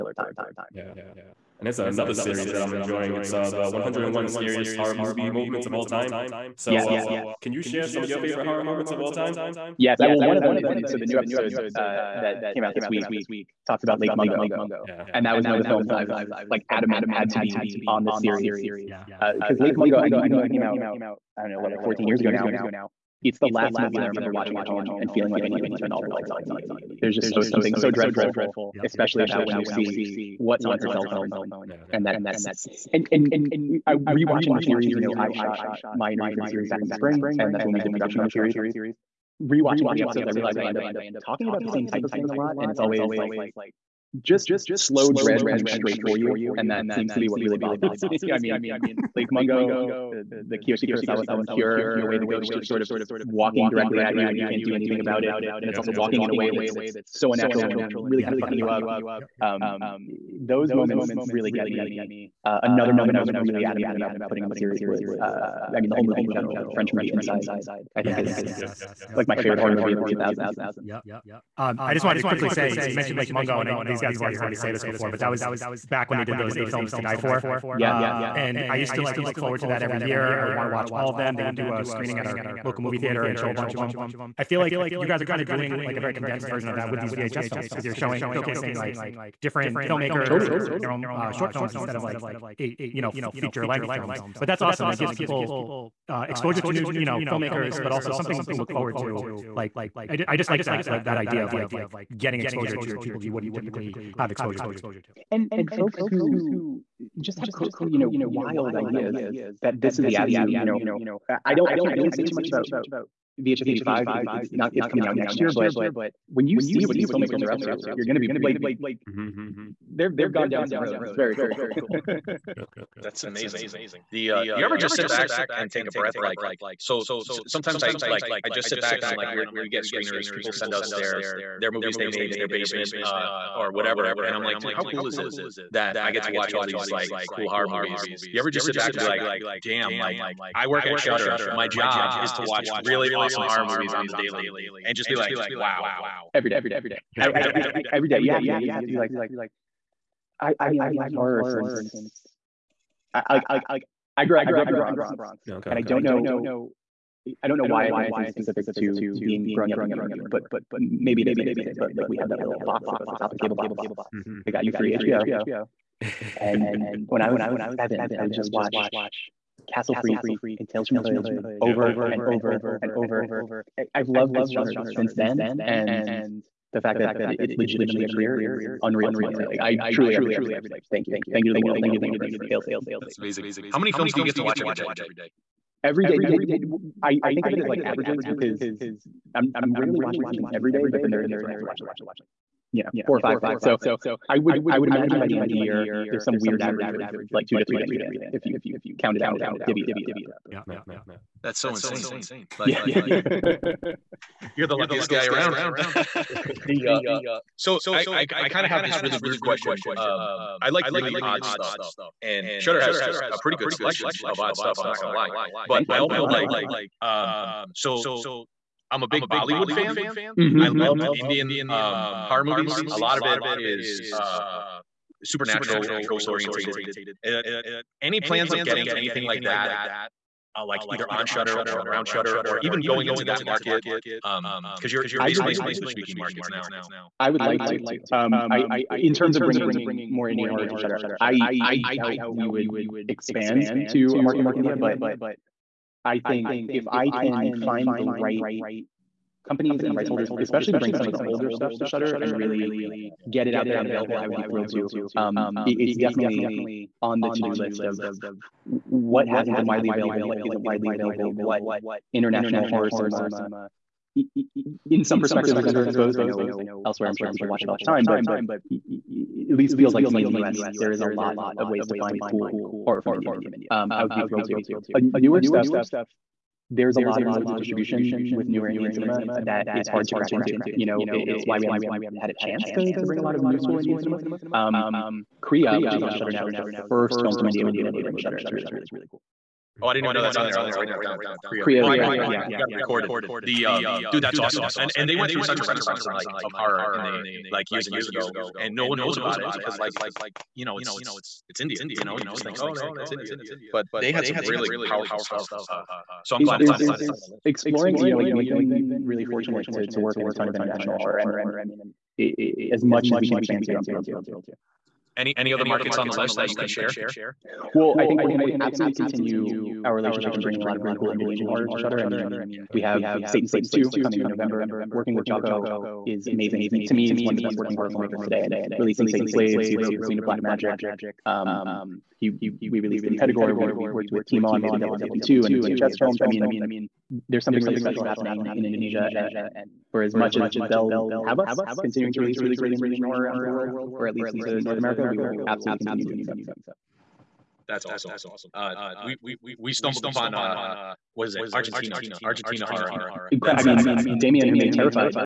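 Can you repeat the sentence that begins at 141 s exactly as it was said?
My job is to watch really awesome horror movies on the daily and just be like, wow.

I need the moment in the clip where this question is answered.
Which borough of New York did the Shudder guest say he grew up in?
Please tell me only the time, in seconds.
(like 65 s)
154 s.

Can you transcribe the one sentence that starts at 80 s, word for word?
I would want to watch all of them.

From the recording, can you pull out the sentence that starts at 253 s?
get it out there and available, I would be thrilled to.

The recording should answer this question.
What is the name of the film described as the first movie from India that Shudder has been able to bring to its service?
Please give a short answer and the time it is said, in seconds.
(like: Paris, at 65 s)
Kriya, at 285 s.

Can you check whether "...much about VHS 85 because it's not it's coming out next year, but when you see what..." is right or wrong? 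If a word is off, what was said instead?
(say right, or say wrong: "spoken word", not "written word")
right.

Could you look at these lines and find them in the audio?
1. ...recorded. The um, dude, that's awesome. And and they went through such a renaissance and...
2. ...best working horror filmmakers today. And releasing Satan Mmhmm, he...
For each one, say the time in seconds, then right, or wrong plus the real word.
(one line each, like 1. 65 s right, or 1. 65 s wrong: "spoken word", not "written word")
1. 292 s right
2. 327 s wrong: "Slaves", not "Mmhmm".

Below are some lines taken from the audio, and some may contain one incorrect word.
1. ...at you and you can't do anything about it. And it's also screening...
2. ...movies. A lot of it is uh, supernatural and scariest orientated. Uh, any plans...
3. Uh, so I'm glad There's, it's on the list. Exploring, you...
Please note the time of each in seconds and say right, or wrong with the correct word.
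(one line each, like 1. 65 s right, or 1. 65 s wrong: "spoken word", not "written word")
1. 54 s wrong: "walking", not "screening"
2. 222 s wrong: "ghost", not "scariest"
3. 305 s right.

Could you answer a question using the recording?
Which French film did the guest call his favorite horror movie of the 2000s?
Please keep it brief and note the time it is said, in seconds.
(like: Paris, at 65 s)
Inside, at 67 s.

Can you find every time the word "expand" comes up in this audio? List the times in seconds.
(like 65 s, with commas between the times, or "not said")
243 s, 313 s.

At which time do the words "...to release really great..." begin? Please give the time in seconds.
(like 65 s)
342 s.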